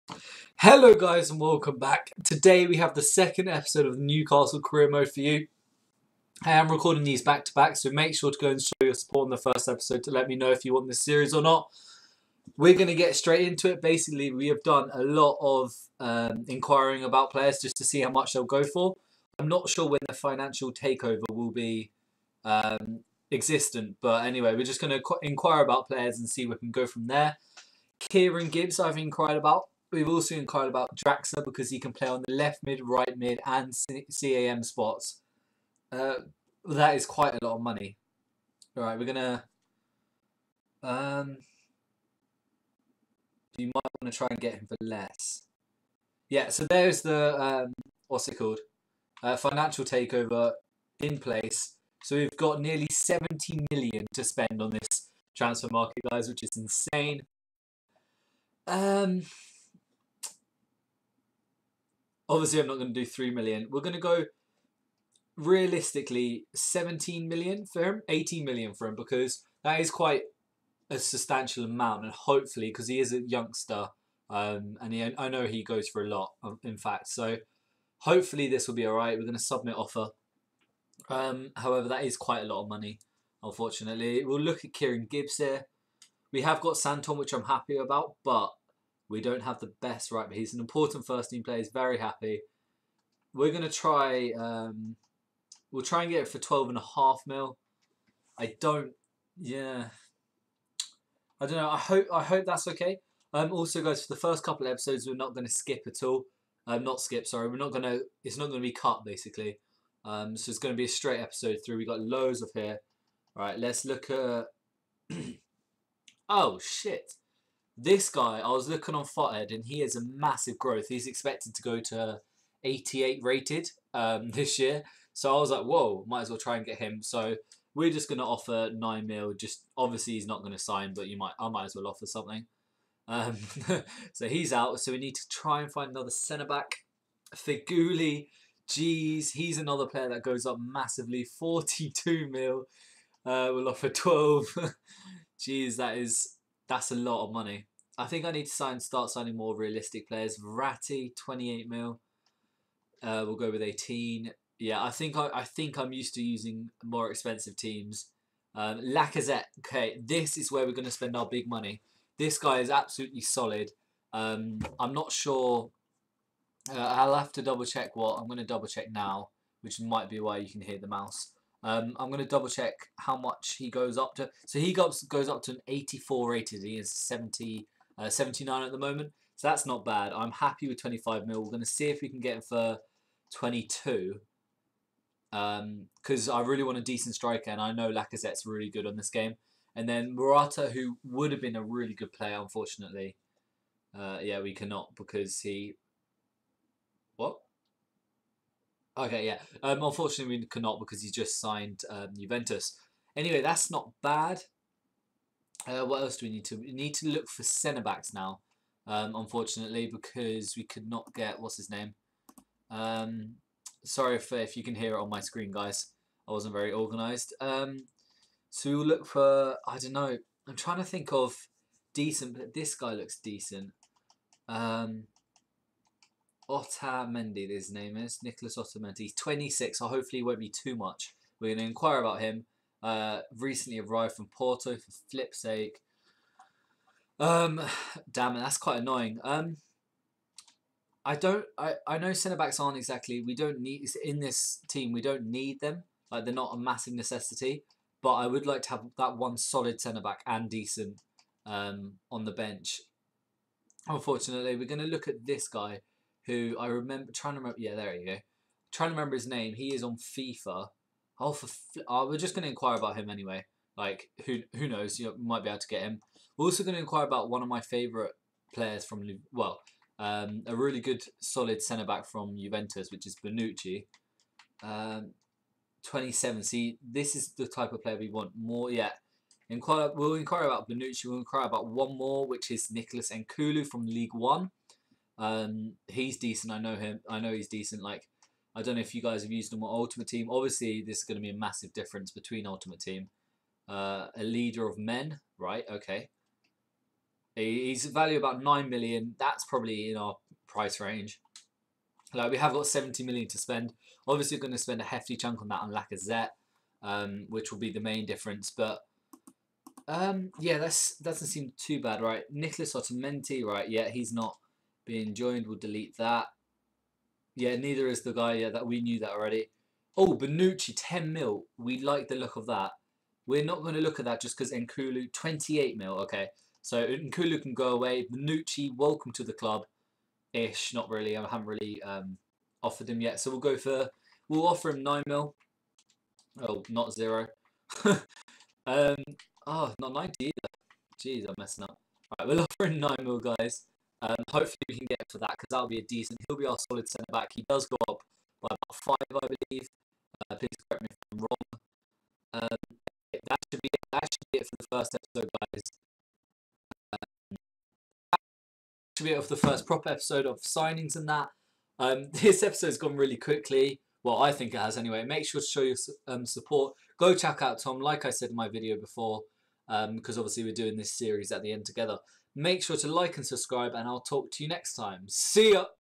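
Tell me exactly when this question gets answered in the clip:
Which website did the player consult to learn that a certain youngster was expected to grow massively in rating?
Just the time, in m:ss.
1:59.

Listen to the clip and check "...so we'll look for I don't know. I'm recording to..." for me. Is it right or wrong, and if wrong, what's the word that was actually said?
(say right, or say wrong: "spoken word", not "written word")
wrong: "trying", not "recording".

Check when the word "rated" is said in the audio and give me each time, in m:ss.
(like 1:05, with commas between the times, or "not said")
2:03, 2:56.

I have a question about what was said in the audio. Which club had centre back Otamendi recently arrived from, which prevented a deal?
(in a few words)
Porto.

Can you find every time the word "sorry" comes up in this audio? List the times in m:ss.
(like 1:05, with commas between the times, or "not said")
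1:47, 3:33.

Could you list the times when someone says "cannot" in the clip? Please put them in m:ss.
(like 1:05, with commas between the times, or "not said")
3:14, 3:20.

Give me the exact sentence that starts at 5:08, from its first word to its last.
But, um, yeah, that doesn't seem too bad, right?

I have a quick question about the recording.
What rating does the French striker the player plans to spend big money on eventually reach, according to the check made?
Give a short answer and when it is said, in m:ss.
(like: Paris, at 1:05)
84, at 2:55.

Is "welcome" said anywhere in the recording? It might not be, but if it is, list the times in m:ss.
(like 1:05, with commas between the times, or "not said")
0:01, 5:28.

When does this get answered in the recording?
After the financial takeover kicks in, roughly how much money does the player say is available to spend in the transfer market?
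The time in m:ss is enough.
0:52.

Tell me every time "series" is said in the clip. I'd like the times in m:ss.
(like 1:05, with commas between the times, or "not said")
0:11, 6:10.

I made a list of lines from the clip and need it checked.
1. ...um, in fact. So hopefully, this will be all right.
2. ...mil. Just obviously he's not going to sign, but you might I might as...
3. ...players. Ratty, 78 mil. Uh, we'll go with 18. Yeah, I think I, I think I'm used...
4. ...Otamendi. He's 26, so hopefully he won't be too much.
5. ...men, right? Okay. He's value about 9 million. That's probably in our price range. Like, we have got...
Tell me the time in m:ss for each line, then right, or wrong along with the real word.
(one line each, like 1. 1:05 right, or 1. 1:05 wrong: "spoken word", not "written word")
1. 1:16 right
2. 2:09 right
3. 2:30 wrong: "28", not "78"
4. 3:48 right
5. 4:54 right.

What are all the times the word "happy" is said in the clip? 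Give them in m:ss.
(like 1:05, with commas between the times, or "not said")
1:27, 1:31, 3:00.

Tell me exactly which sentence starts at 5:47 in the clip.
He does go up by about five, I believe.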